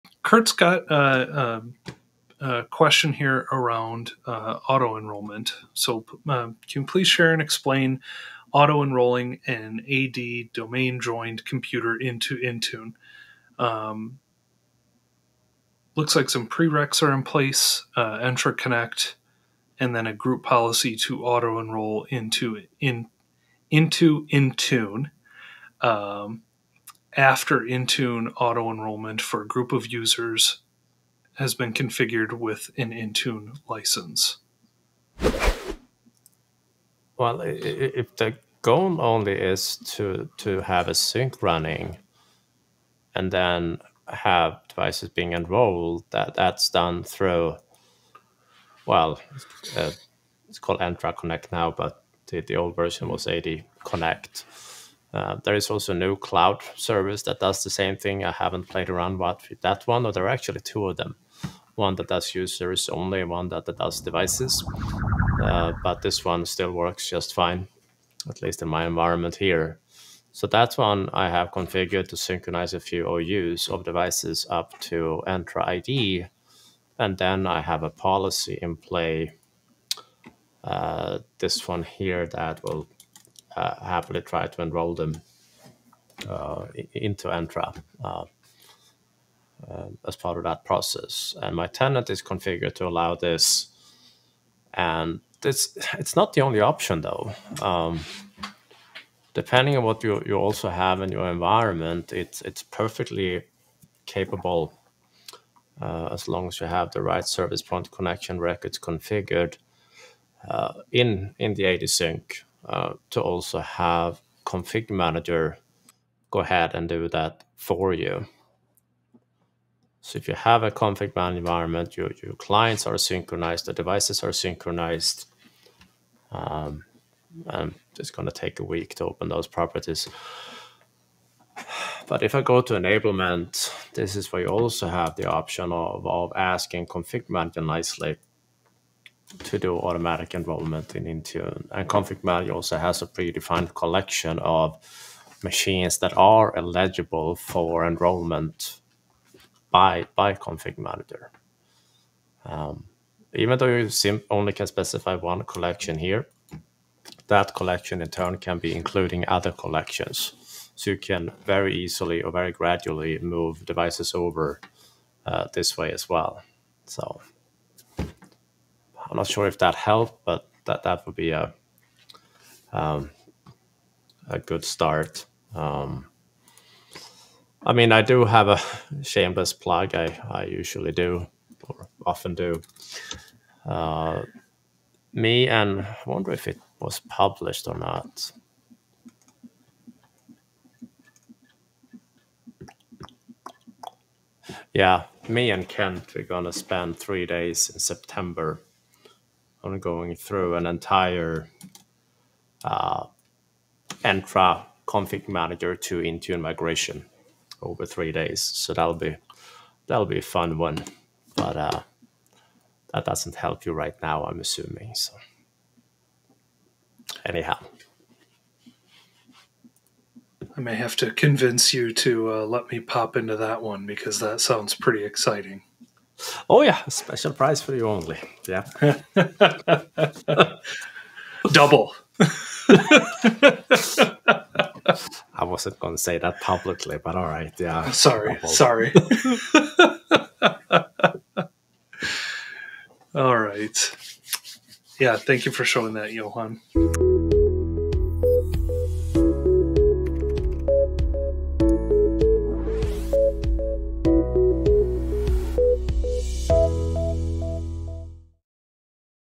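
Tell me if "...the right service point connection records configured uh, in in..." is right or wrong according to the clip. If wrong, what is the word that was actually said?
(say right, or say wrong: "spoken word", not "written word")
right.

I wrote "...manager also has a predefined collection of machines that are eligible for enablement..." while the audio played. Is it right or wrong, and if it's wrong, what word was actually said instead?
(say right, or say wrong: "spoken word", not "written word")
wrong: "enrollment", not "enablement".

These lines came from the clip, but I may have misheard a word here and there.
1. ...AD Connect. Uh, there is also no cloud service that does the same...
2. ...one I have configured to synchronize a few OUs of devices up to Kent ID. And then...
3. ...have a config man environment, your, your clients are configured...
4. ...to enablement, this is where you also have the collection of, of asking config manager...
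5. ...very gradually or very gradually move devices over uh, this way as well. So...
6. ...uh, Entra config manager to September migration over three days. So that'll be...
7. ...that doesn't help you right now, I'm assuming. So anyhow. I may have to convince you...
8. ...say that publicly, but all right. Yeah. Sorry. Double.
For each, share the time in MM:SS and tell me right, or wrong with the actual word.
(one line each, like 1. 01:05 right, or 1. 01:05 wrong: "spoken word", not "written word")
1. 00:53 right
2. 01:10 wrong: "Entra", not "Kent"
3. 02:00 wrong: "synchronized", not "configured"
4. 02:12 wrong: "option", not "collection"
5. 02:41 wrong: "easily", not "gradually"
6. 03:22 wrong: "Intune", not "September"
7. 03:32 right
8. 03:56 right.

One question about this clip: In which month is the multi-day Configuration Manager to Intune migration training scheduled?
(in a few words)
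September.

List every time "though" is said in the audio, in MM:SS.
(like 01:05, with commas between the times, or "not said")
01:37, 02:33.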